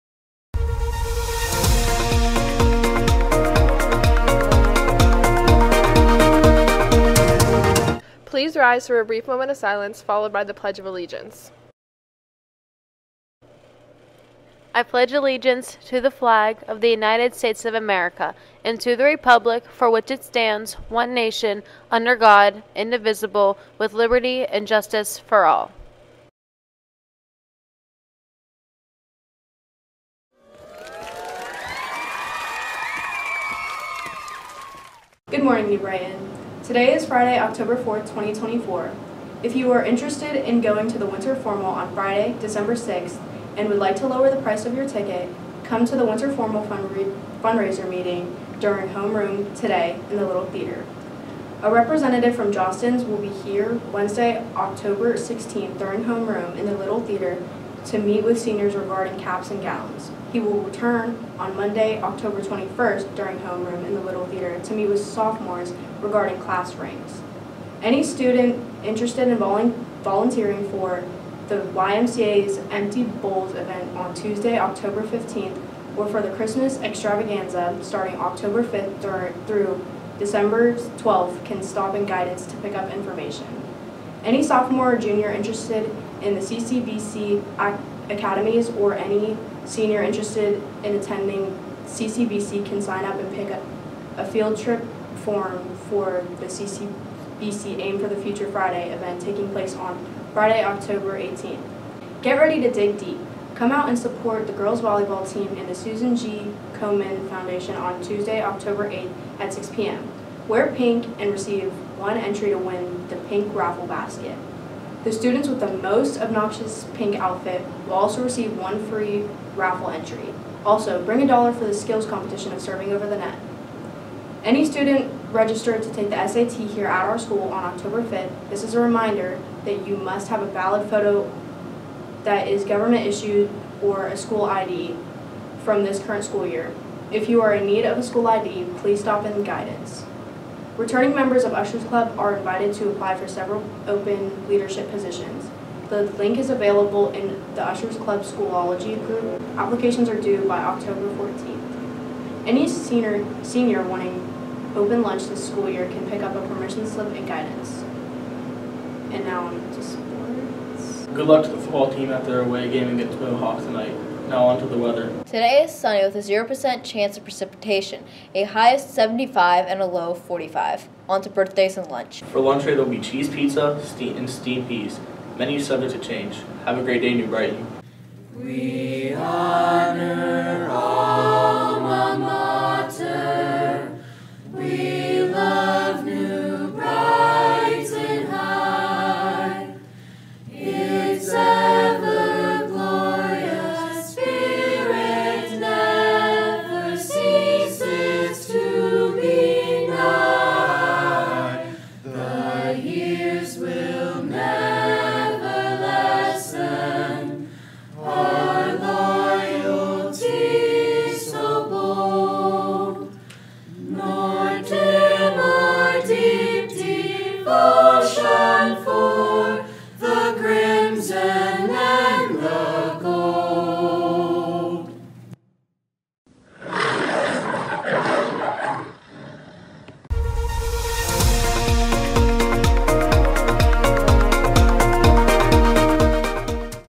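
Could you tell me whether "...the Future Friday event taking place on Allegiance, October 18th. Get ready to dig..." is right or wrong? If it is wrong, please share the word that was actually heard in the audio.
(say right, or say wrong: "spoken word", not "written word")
wrong: "Friday", not "Allegiance".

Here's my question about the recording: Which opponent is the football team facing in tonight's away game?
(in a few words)
Mohawk.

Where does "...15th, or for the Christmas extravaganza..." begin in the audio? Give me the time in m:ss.
1:15.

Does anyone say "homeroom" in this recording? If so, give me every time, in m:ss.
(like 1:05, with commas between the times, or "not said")
0:48, 0:56, 1:03.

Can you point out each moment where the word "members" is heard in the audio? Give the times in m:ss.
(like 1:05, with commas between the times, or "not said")
2:21.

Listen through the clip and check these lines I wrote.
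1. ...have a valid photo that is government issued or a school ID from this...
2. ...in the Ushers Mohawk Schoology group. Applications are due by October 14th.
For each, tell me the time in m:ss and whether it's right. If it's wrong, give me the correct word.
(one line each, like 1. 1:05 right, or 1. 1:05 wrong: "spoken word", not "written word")
1. 2:10 right
2. 2:27 wrong: "Club", not "Mohawk".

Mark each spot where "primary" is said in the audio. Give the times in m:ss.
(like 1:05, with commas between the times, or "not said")
not said.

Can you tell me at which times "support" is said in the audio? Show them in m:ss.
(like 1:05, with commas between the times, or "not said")
1:43.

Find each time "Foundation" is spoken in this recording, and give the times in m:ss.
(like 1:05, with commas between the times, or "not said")
1:47.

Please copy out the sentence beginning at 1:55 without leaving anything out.
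The students with the most obnoxious pink outfit will also receive one free raffle entry.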